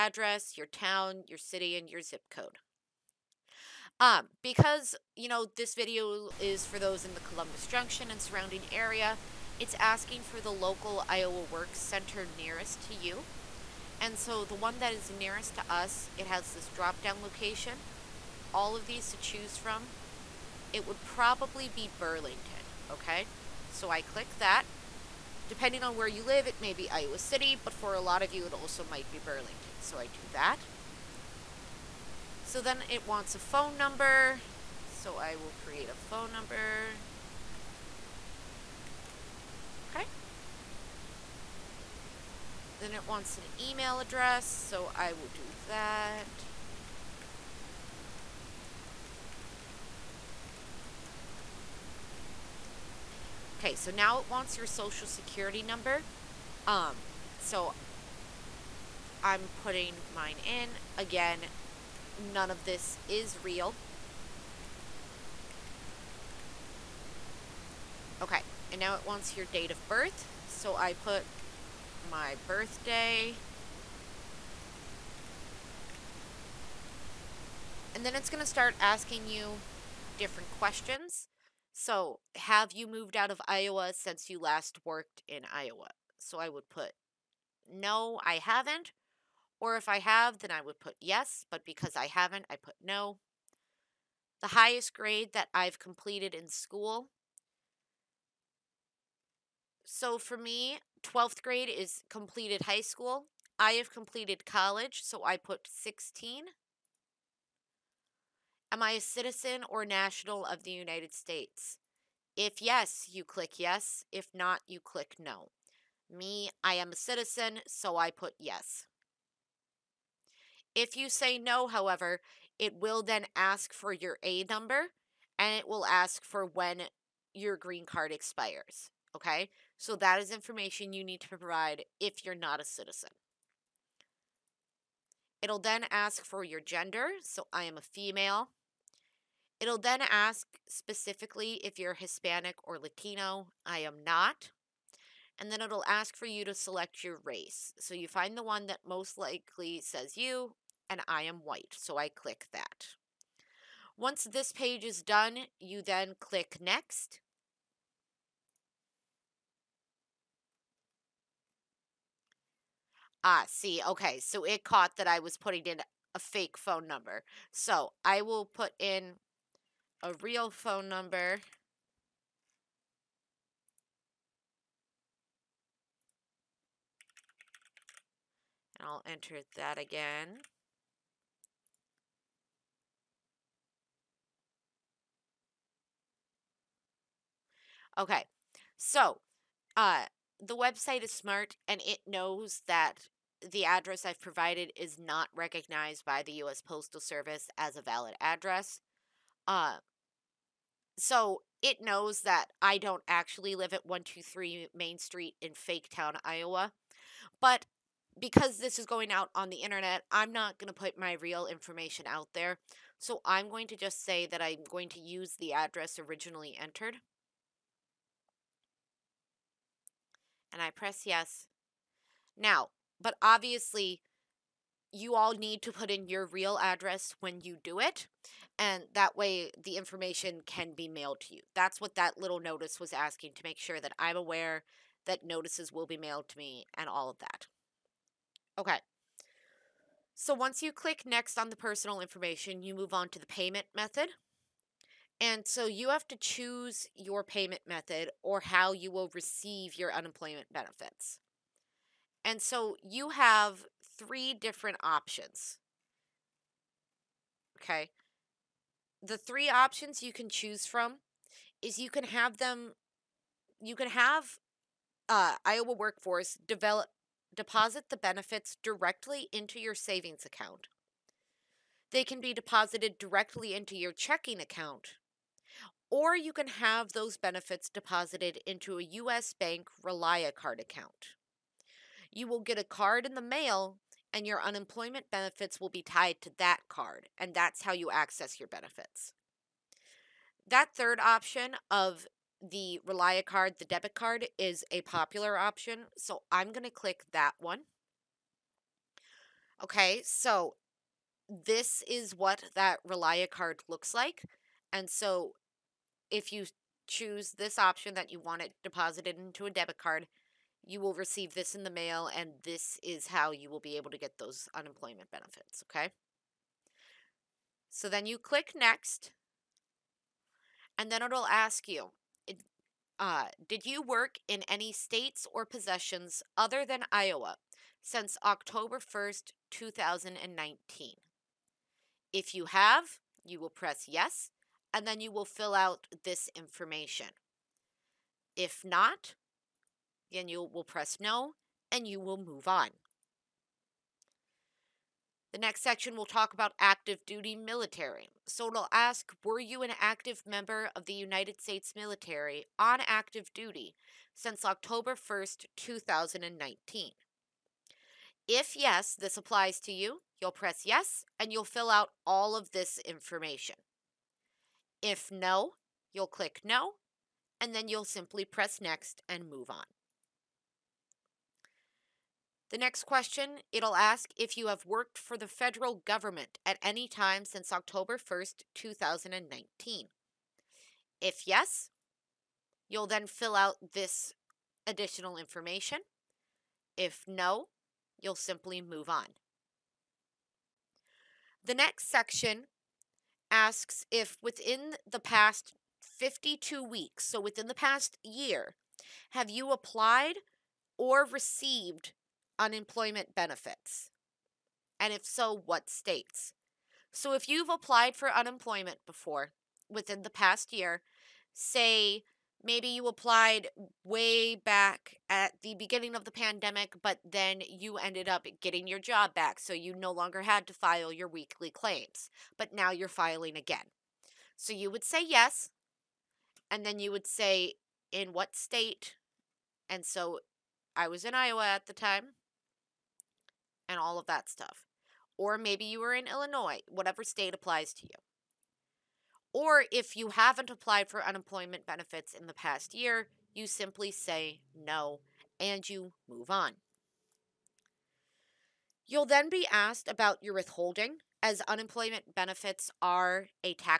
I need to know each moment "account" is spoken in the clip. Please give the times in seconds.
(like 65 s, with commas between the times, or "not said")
270 s, 274 s, 280 s.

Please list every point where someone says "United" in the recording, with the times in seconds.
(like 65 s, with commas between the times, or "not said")
110 s, 350 s.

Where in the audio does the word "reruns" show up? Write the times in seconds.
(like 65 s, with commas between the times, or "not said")
not said.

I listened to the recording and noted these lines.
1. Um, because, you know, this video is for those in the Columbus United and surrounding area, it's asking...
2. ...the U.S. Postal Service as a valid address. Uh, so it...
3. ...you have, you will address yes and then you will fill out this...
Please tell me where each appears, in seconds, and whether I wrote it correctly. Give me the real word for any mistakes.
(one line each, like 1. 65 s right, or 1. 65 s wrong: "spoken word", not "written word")
1. 3 s wrong: "Junction", not "United"
2. 196 s right
3. 332 s wrong: "press", not "address".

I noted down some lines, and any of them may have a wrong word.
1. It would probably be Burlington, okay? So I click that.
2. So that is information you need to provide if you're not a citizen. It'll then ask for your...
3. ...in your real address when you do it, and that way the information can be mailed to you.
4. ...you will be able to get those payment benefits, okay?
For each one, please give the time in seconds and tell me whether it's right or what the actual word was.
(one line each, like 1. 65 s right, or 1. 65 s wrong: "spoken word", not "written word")
1. 20 s right
2. 129 s right
3. 225 s right
4. 313 s wrong: "unemployment", not "payment".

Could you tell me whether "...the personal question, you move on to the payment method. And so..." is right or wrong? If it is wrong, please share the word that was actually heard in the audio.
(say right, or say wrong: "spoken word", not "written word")
wrong: "information", not "question".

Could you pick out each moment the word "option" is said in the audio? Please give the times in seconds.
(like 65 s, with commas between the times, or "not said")
254 s, 259 s, 290 s, 295 s, 307 s.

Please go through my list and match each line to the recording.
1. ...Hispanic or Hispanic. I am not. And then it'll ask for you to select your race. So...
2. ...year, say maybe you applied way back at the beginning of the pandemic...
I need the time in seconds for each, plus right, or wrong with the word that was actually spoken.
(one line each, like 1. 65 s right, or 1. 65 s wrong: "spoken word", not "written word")
1. 141 s wrong: "Latino", not "Hispanic"
2. 410 s right.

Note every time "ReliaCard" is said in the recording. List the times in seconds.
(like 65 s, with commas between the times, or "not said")
279 s, 292 s, 302 s.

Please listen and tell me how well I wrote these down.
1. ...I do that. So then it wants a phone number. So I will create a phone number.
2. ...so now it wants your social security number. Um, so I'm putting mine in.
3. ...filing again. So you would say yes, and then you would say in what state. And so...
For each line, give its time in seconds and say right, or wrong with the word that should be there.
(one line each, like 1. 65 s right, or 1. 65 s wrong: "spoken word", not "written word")
1. 29 s right
2. 53 s right
3. 422 s right.